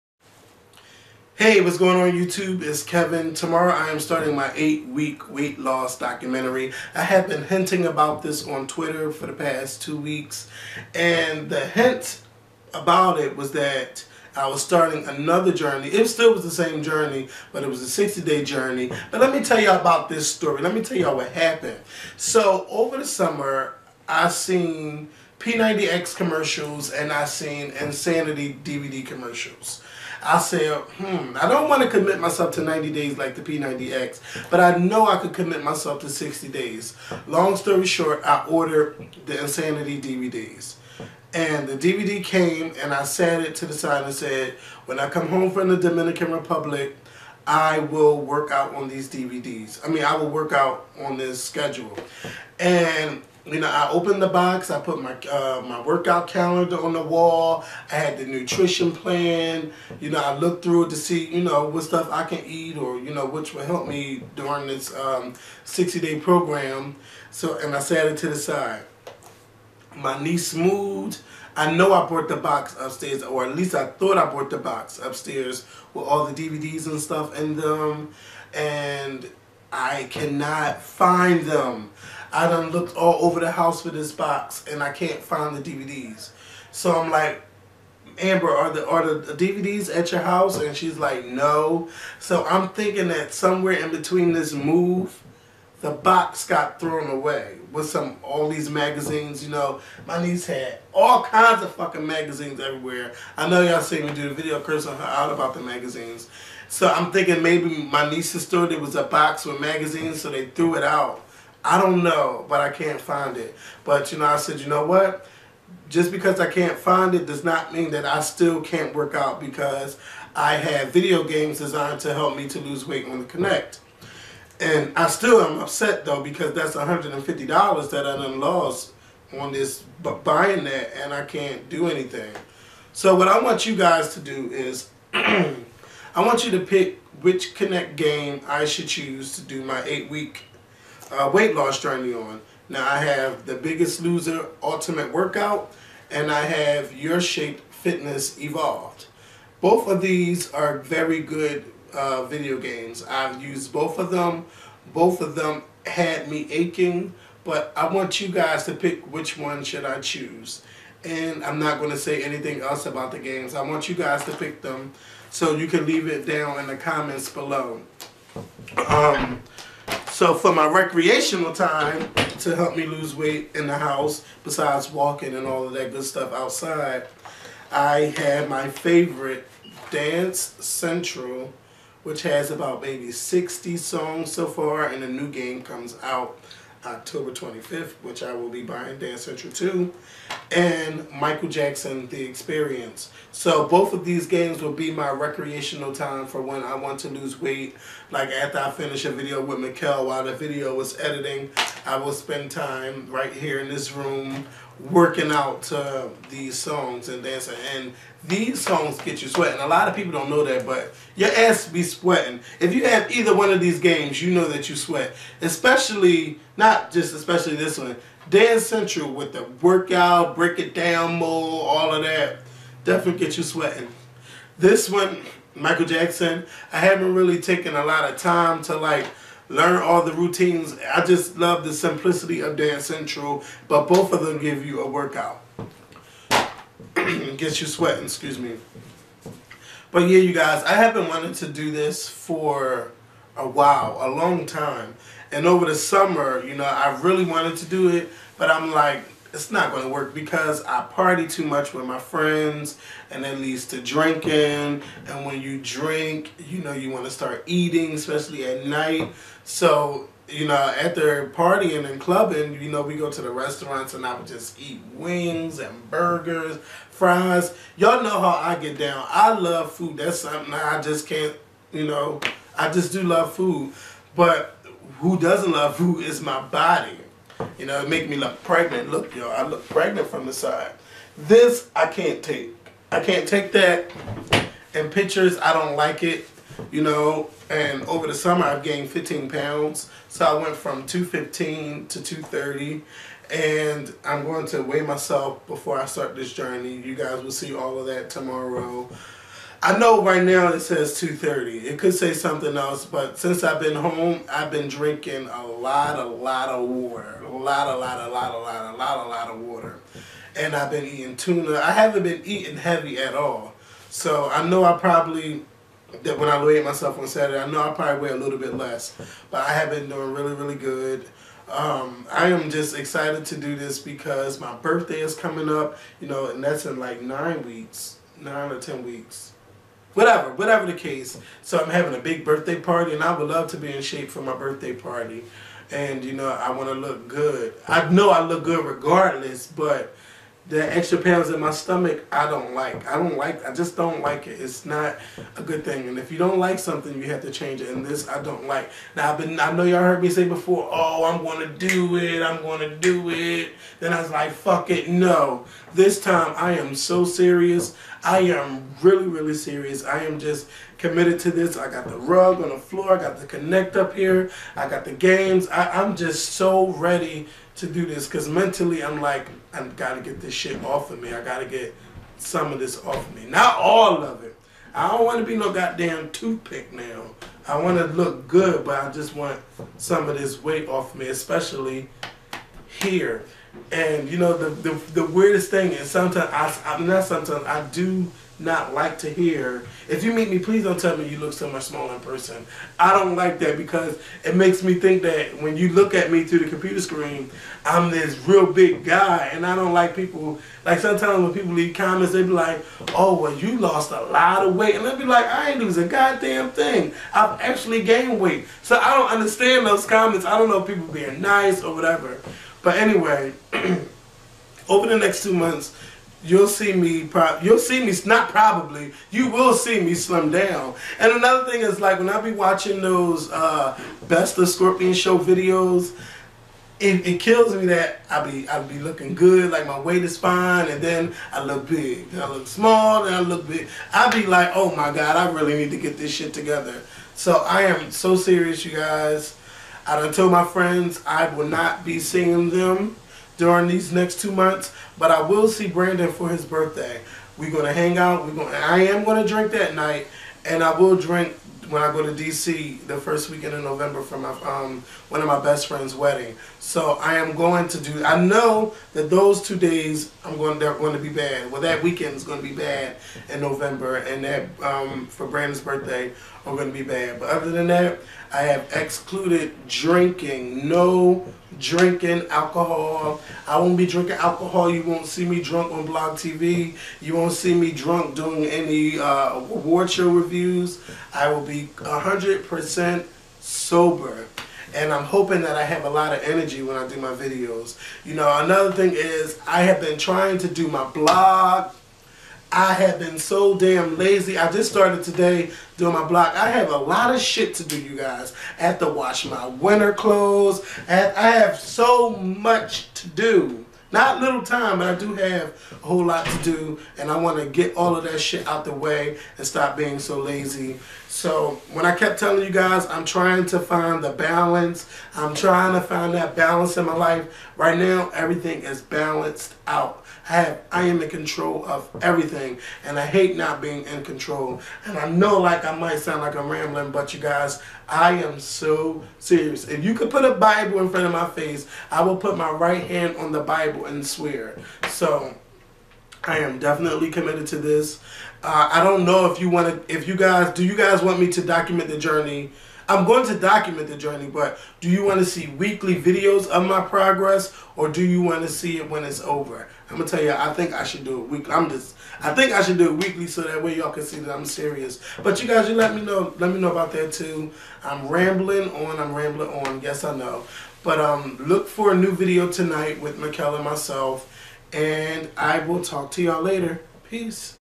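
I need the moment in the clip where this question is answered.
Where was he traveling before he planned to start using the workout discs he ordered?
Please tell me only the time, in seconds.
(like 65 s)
45 s.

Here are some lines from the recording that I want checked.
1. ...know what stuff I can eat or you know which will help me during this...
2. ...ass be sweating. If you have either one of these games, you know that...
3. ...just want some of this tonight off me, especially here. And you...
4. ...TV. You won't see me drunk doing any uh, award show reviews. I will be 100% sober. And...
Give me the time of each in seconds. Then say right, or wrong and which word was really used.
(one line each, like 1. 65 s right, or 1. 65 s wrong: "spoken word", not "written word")
1. 61 s right
2. 211 s right
3. 378 s wrong: "weight", not "tonight"
4. 476 s right.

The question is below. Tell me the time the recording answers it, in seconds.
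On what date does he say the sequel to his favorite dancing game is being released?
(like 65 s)
186 s.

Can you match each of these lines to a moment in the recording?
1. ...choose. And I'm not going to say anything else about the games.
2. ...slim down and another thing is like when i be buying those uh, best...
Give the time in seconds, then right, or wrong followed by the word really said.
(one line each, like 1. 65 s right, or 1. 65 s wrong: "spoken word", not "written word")
1. 159 s right
2. 419 s wrong: "watching", not "buying".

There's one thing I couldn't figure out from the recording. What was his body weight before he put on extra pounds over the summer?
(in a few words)
215.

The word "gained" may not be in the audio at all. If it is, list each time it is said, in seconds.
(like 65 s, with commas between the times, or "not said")
288 s, 407 s.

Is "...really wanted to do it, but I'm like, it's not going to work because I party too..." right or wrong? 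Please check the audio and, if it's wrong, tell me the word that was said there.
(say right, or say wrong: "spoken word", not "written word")
right.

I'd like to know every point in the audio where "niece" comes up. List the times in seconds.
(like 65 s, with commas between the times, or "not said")
70 s, 100 s, 108 s.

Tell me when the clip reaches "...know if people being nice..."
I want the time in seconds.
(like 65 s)
410 s.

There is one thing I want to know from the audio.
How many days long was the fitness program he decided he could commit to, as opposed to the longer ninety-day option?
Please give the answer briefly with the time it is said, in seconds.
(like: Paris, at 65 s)
60, at 36 s.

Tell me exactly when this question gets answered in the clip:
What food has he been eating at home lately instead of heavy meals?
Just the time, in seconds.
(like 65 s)
311 s.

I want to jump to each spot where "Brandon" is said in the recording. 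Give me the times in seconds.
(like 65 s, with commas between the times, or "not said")
445 s, 465 s.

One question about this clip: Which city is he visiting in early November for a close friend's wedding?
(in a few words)
DC.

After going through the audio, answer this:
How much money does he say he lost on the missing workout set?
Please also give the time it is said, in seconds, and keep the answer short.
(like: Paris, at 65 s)
$150, at 126 s.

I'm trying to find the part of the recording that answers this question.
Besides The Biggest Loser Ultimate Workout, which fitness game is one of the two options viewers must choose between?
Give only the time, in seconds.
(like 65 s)
146 s.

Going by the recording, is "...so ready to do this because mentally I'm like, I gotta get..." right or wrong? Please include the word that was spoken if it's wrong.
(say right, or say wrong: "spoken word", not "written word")
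right.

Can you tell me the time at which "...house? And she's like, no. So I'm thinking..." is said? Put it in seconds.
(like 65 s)
90 s.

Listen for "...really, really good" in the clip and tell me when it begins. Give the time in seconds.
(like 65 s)
320 s.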